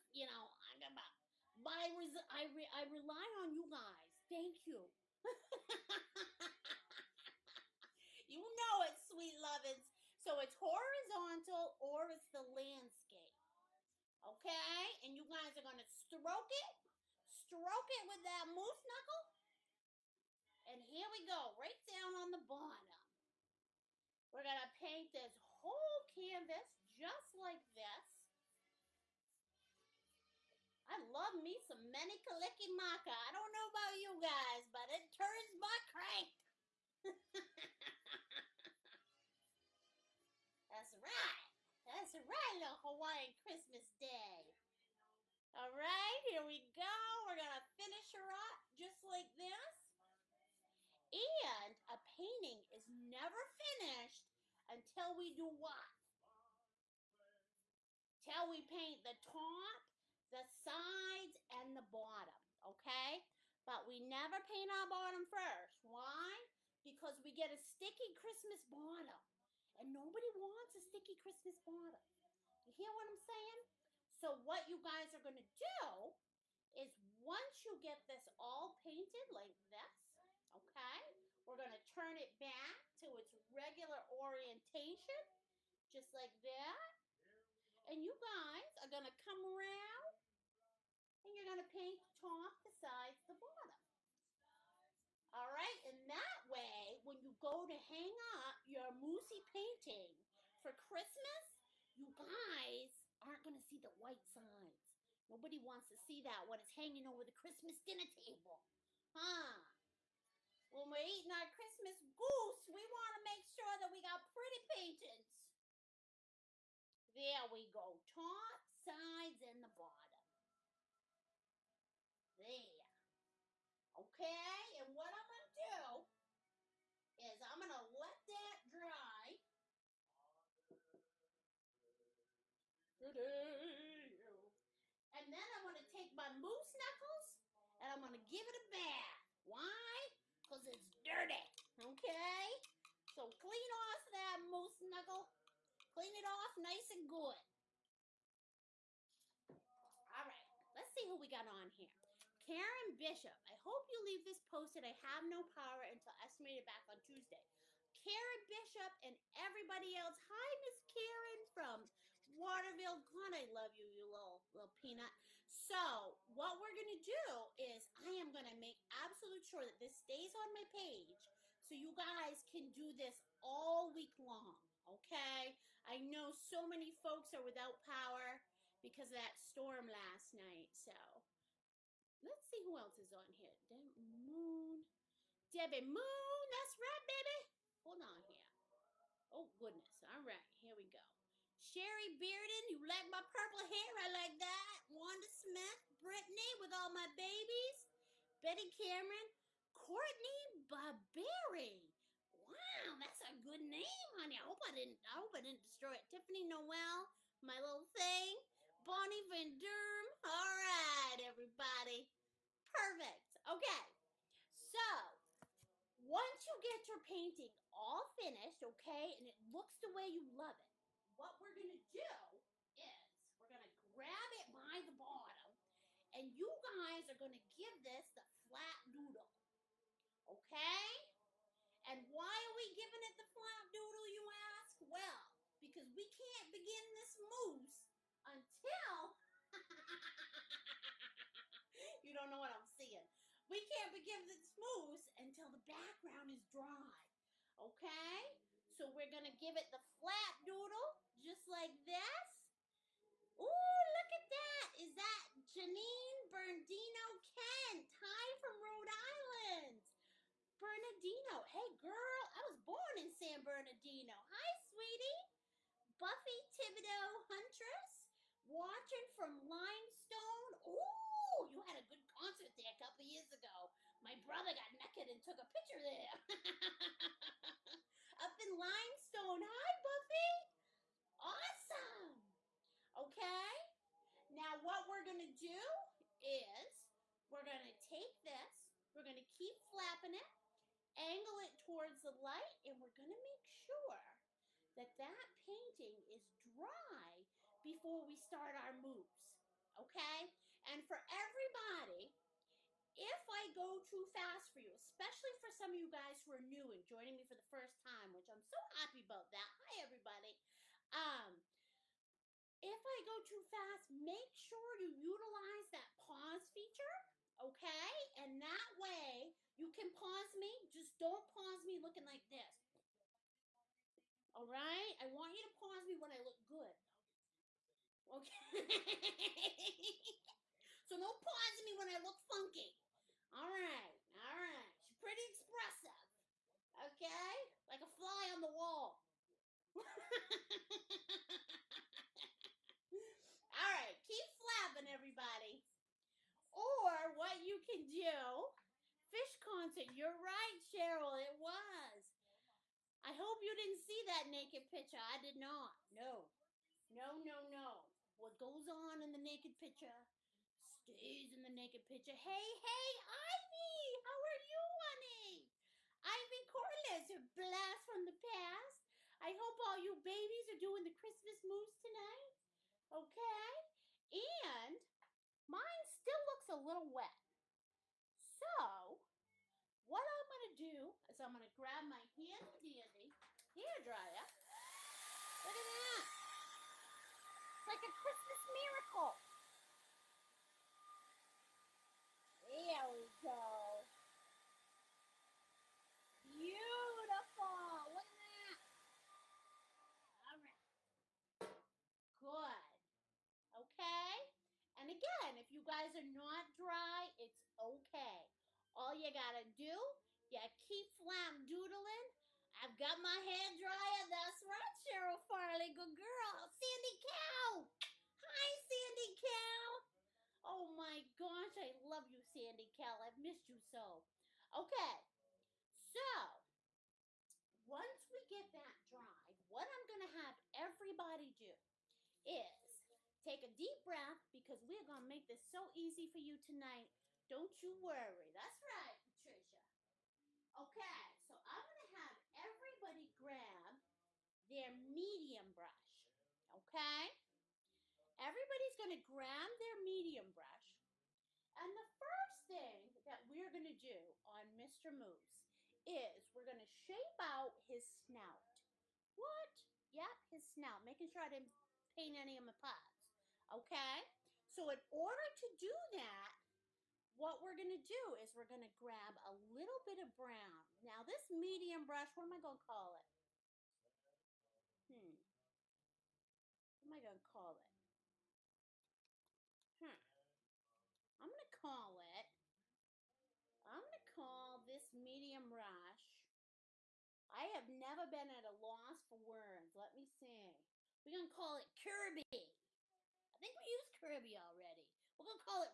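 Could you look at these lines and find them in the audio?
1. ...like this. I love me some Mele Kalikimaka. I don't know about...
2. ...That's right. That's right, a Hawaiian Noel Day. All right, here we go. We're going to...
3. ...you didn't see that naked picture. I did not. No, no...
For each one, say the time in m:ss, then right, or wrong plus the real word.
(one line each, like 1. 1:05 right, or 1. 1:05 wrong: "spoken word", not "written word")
1. 0:27 right
2. 0:40 wrong: "Christmas", not "Noel"
3. 5:53 right.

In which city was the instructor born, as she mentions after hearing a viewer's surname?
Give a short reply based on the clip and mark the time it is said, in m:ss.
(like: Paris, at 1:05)
San Bernardino, at 4:23.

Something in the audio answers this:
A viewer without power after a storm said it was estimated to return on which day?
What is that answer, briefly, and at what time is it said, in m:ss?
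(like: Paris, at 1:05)
Tuesday, at 2:37.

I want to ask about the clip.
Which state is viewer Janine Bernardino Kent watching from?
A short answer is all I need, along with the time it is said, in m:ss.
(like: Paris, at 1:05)
Rhode Island, at 4:18.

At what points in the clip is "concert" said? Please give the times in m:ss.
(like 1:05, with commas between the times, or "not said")
4:32, 5:49.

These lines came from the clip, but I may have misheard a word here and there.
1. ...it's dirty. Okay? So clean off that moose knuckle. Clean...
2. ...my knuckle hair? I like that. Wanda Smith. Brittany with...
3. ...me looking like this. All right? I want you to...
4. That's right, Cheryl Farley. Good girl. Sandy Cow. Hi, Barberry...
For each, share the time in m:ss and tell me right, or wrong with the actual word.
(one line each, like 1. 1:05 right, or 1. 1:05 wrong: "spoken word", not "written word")
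1. 2:20 right
2. 3:13 wrong: "purple", not "knuckle"
3. 5:21 right
4. 6:54 wrong: "Sandy", not "Barberry".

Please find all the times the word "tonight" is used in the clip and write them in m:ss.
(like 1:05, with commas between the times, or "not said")
6:11, 7:16.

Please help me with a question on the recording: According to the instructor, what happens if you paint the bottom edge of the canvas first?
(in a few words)
a sticky Christmas bottom.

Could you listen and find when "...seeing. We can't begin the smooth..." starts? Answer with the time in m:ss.
4:02.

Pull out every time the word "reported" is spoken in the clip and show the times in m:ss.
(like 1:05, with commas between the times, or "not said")
not said.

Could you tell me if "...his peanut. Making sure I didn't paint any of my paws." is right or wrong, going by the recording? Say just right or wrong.
wrong.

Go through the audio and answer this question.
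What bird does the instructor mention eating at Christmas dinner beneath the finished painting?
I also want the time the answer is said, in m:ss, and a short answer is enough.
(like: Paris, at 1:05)
Christmas goose, at 1:51.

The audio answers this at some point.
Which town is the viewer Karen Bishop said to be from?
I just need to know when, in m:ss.
2:42.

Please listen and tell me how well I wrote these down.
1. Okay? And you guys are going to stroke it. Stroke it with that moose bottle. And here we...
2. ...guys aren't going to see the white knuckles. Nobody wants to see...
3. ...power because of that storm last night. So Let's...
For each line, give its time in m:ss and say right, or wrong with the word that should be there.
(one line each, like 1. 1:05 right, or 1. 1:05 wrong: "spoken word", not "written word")
1. 0:14 wrong: "knuckle", not "bottle"
2. 1:42 wrong: "sides", not "knuckles"
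3. 2:57 right.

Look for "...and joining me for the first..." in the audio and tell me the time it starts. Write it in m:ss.
5:06.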